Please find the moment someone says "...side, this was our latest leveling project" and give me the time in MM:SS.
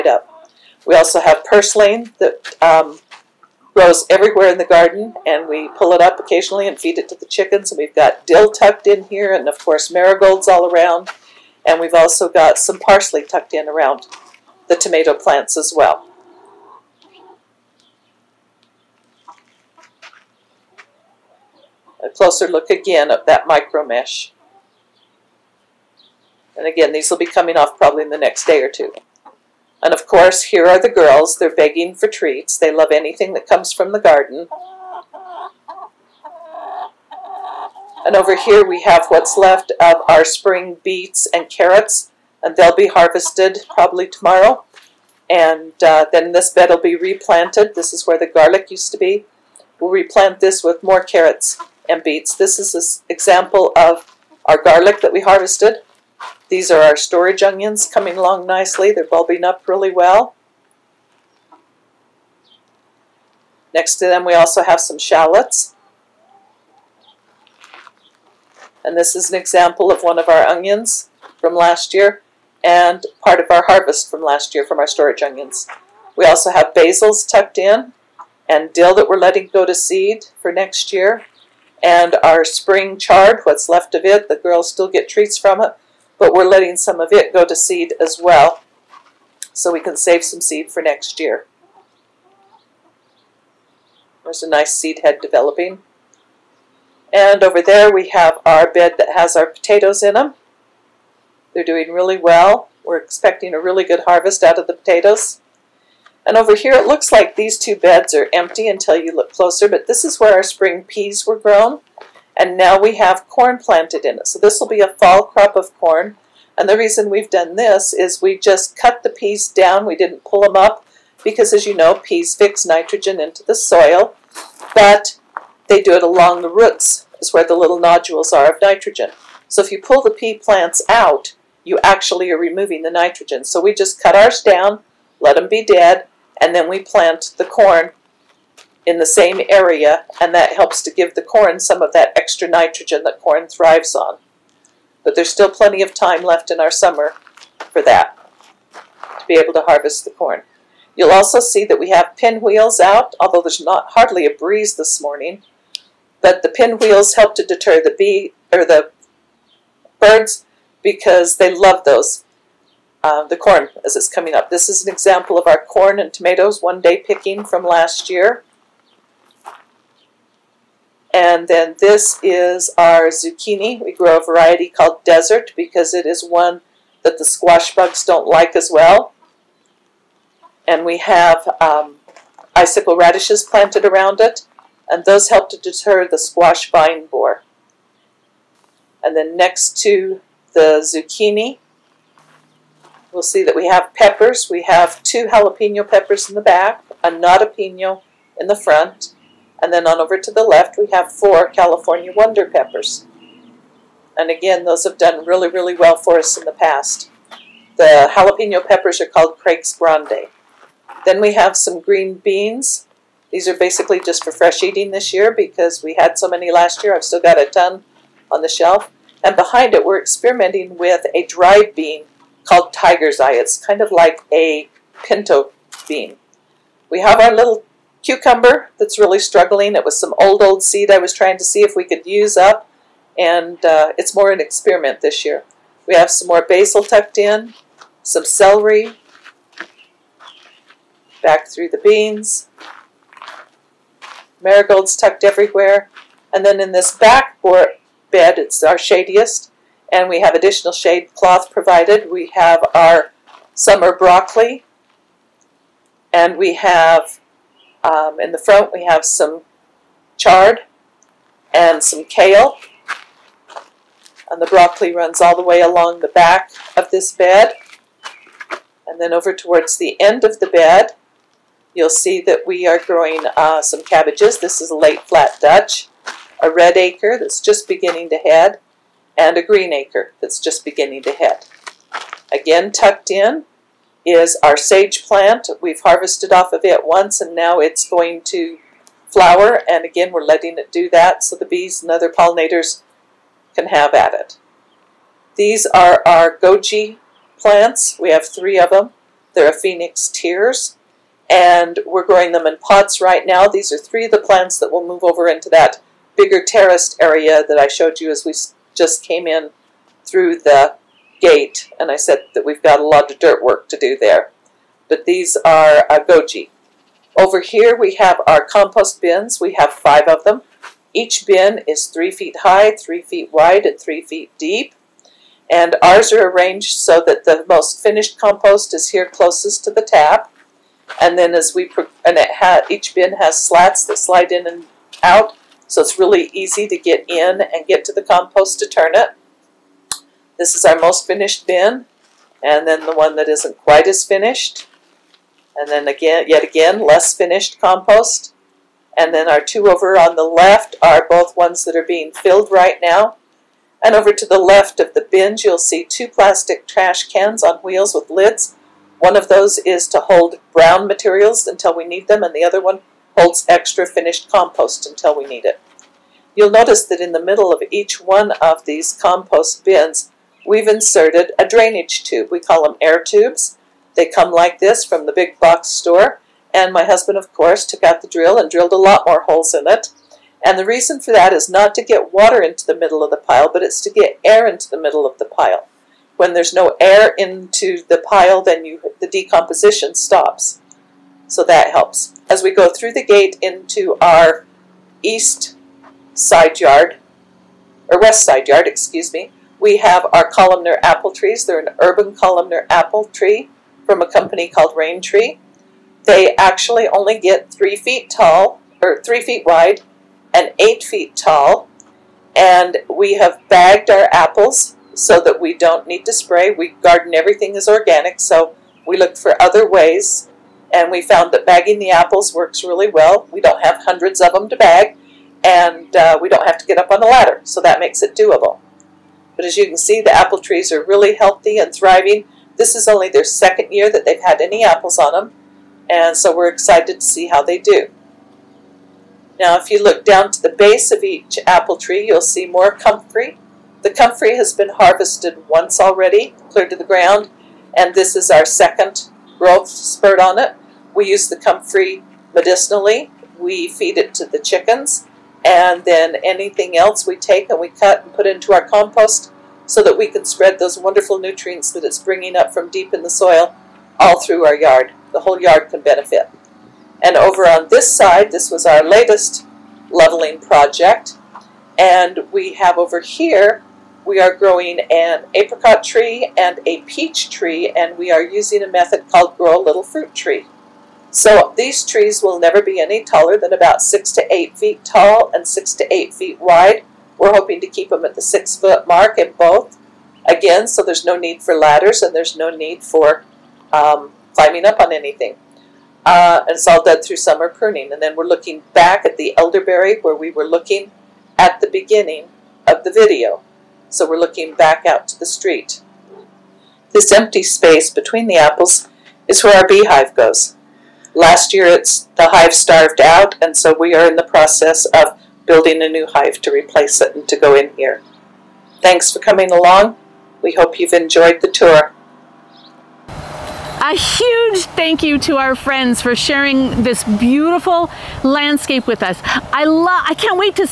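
07:47.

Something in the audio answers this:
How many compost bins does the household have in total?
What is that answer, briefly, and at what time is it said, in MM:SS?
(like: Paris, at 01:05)
5, at 05:19.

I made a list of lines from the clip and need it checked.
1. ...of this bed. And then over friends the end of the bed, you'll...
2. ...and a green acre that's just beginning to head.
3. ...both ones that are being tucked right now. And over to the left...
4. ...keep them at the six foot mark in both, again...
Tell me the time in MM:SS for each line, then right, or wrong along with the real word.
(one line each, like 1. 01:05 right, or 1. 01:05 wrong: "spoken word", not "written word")
1. 04:26 wrong: "towards", not "friends"
2. 04:39 right
3. 05:51 wrong: "filled", not "tucked"
4. 08:07 right.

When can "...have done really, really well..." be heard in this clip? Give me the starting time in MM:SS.
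03:24.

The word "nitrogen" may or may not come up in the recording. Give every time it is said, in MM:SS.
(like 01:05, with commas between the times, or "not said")
02:02, 02:08, 02:12, 02:22.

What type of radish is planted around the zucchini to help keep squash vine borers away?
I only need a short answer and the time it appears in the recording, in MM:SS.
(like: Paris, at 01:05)
Icicle, at 03:02.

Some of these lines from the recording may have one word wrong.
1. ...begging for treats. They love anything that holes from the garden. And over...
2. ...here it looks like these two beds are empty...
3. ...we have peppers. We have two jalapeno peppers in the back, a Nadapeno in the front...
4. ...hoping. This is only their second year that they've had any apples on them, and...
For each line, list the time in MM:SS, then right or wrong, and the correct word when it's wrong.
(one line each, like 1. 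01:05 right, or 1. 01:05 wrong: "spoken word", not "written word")
1. 00:31 wrong: "comes", not "holes"
2. 01:46 right
3. 03:13 right
4. 07:11 wrong: "thriving", not "hoping".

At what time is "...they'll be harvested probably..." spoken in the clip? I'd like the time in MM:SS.
00:42.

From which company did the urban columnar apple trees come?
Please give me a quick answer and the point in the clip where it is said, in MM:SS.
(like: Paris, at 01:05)
Raintree, at 06:44.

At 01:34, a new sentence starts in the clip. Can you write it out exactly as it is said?
There's a nice seed head developing.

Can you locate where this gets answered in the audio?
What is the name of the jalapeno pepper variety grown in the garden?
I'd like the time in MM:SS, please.
03:29.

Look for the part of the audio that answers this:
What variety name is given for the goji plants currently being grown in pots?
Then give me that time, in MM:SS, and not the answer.
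04:59.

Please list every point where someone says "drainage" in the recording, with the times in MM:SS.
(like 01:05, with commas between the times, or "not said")
06:11.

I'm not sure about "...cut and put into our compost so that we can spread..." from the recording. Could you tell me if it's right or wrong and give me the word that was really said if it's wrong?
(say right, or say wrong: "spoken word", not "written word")
right.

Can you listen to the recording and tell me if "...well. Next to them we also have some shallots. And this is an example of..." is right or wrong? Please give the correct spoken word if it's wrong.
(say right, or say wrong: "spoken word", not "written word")
right.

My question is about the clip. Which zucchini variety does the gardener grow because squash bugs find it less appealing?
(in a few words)
Desert.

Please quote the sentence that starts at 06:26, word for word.
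When there's no air into the pile, then you, the decomposition stops.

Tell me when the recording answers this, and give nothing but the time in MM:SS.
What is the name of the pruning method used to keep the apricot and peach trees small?
07:59.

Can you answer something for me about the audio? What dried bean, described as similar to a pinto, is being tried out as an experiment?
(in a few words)
Tiger's Eye.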